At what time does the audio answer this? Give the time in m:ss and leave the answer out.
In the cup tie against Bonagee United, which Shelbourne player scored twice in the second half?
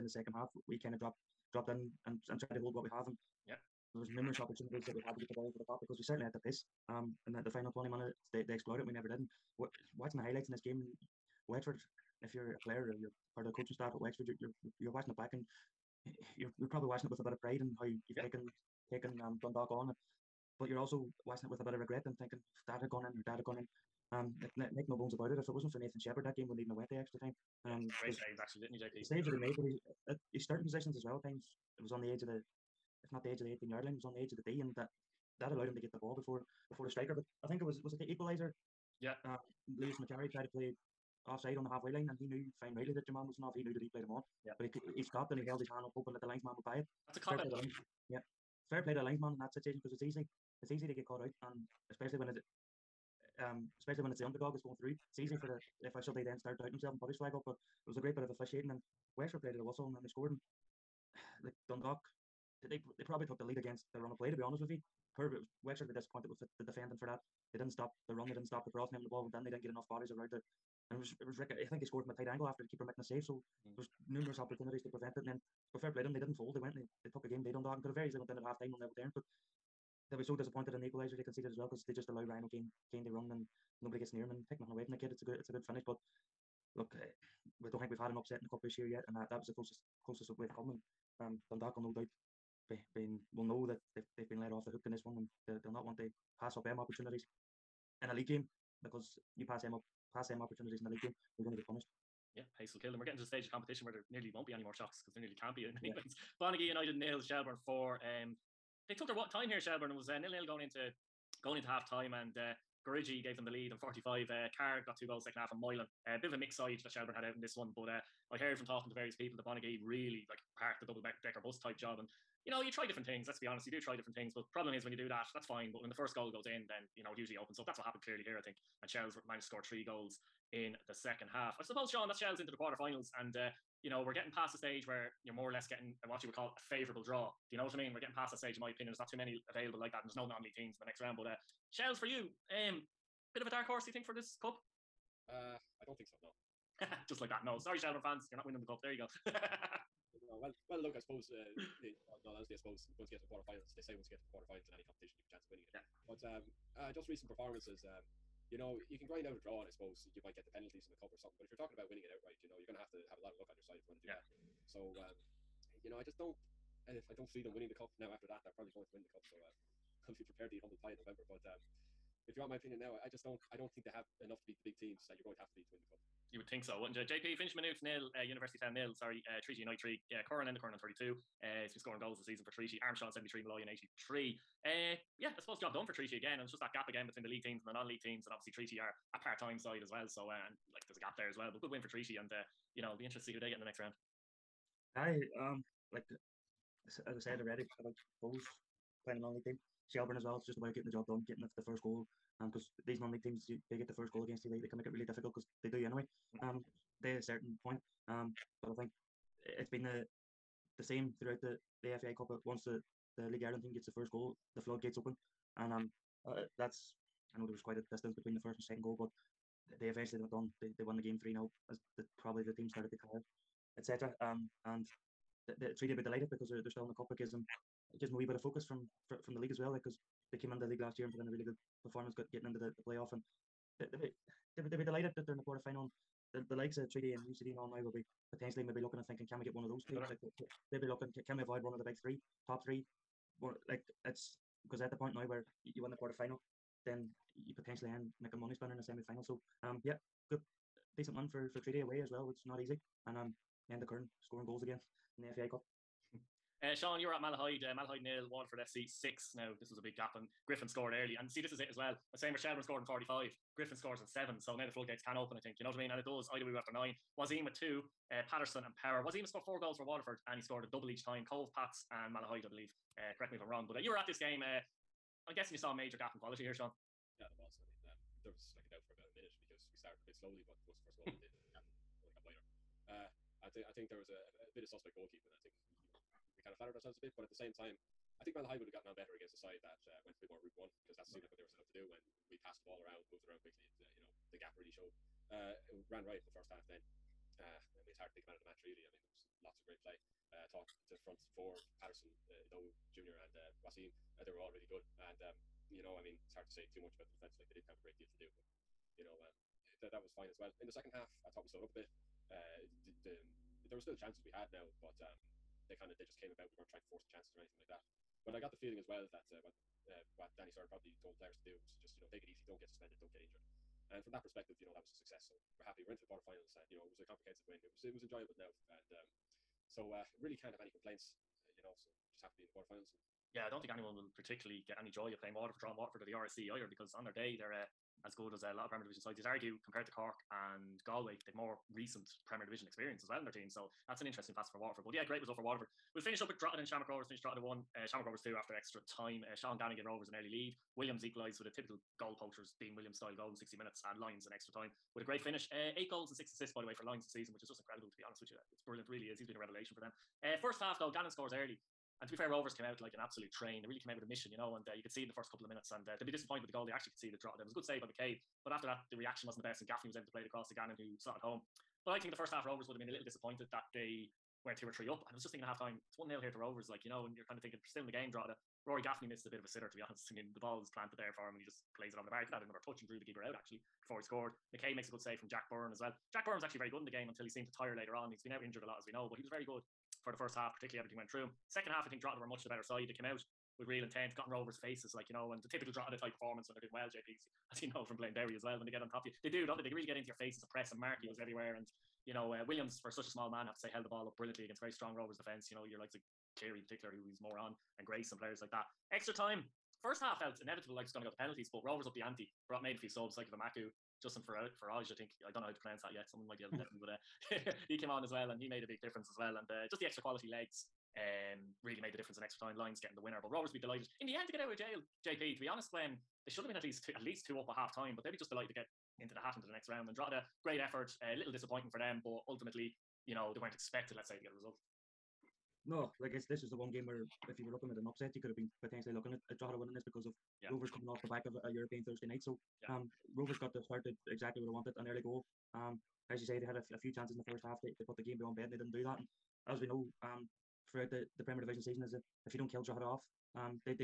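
1:54.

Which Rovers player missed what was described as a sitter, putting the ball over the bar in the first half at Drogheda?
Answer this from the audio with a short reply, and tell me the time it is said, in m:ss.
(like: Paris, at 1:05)
Rory Gaffney, at 6:18.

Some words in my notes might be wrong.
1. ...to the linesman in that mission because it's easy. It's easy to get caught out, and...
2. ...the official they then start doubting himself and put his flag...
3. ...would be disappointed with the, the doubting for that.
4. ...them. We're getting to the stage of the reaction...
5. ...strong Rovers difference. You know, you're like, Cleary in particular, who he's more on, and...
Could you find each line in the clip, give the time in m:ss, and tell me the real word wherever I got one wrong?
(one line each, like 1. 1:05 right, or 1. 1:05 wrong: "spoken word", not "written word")
1. 0:48 wrong: "situation", not "mission"
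2. 0:55 right
3. 1:05 wrong: "defending", not "doubting"
4. 1:42 wrong: "competition", not "reaction"
5. 6:44 wrong: "defence", not "difference".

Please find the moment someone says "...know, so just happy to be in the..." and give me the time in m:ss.
5:31.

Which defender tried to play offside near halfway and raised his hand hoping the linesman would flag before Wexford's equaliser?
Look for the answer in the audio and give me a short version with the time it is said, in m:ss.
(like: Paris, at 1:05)
Lewis Macari, at 0:39.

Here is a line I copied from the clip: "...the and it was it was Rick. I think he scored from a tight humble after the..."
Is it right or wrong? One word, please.
wrong.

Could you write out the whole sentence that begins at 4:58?
I mean, there was lots of great play.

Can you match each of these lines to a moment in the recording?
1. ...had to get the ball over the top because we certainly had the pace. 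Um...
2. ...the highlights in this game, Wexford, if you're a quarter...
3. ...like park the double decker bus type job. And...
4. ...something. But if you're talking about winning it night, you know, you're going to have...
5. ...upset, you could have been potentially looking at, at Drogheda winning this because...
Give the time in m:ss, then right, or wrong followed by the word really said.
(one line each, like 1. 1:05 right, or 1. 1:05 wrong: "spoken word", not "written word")
1. 0:05 right
2. 0:10 wrong: "player", not "quarter"
3. 2:00 right
4. 2:41 wrong: "outright", not "night"
5. 7:17 right.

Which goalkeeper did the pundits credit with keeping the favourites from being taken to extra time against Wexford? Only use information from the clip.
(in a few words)
Nathan Shepperd.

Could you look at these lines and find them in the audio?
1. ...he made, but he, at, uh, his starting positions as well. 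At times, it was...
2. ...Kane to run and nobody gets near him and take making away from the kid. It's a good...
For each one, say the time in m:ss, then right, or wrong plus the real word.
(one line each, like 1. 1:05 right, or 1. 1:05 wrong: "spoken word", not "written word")
1. 0:29 right
2. 1:22 wrong: "nothing", not "making".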